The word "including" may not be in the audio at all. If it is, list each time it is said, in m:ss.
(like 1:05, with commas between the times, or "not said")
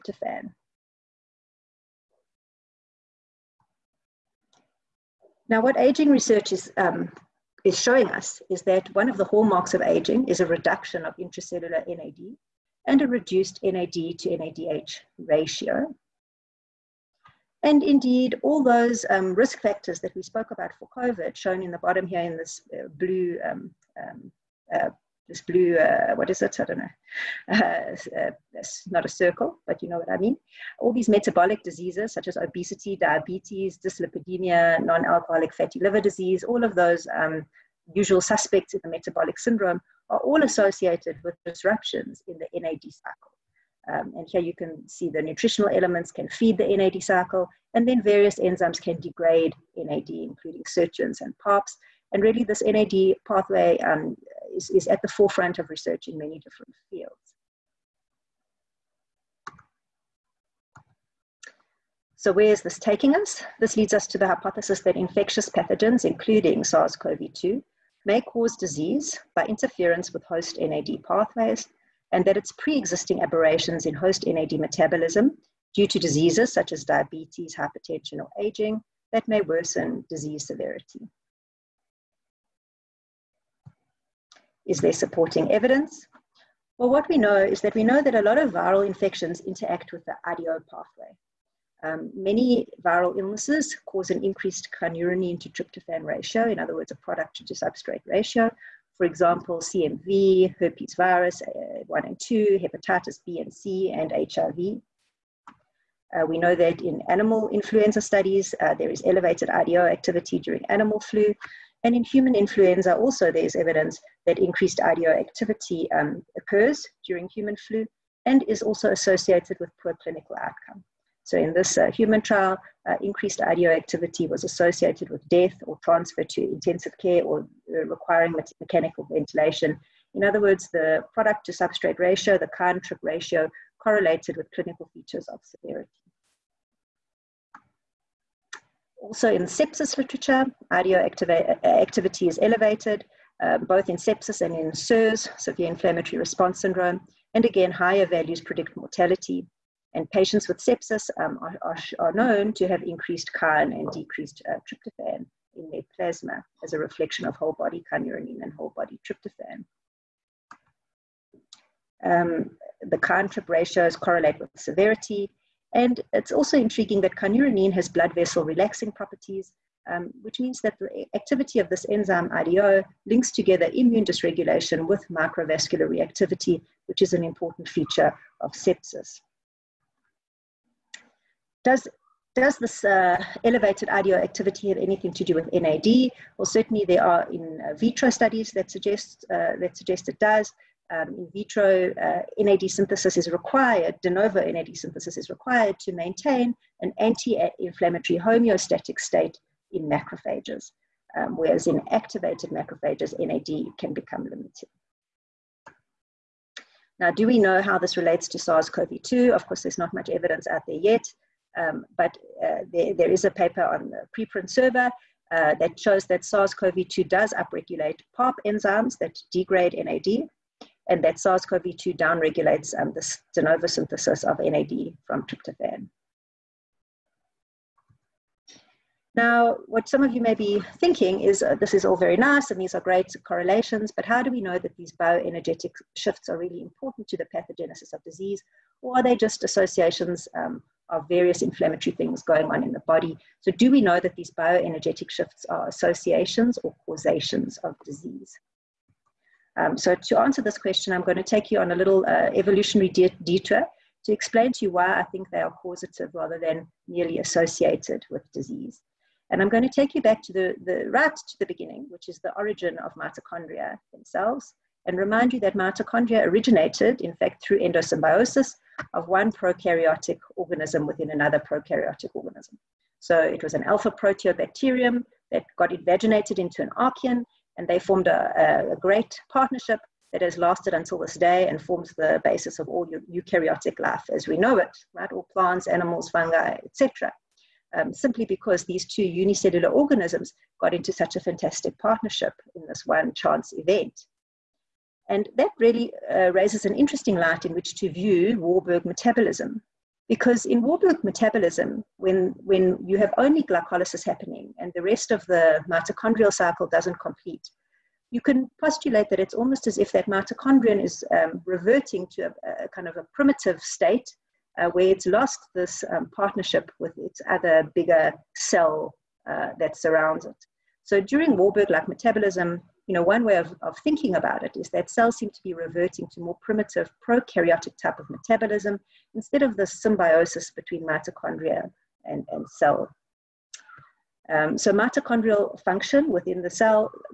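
0:50, 1:06.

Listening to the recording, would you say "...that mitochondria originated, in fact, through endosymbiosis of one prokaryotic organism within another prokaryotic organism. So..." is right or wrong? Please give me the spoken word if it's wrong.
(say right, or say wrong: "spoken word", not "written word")
right.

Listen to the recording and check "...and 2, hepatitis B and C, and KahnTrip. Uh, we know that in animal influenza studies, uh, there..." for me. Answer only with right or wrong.
wrong.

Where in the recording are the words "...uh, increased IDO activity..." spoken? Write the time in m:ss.
2:02.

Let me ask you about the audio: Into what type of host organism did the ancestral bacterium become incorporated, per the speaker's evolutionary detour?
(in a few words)
archaean.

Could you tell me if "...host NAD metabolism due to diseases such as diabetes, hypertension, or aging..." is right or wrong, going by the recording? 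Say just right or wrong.
right.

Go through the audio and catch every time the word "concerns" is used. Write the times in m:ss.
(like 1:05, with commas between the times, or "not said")
not said.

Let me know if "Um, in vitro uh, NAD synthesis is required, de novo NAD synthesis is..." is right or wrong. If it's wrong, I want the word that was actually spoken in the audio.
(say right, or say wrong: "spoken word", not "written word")
right.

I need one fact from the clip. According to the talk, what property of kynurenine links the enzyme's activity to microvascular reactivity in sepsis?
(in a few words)
blood vessel relaxing.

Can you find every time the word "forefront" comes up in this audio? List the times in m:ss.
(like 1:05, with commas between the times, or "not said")
0:55.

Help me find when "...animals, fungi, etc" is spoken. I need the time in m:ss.
4:45.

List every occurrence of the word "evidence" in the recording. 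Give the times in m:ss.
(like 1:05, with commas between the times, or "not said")
1:25, 1:53, 3:30.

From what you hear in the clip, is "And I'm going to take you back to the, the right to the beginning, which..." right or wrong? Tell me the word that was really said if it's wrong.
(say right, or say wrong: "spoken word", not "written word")
right.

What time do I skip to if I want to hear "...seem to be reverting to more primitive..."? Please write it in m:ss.
5:25.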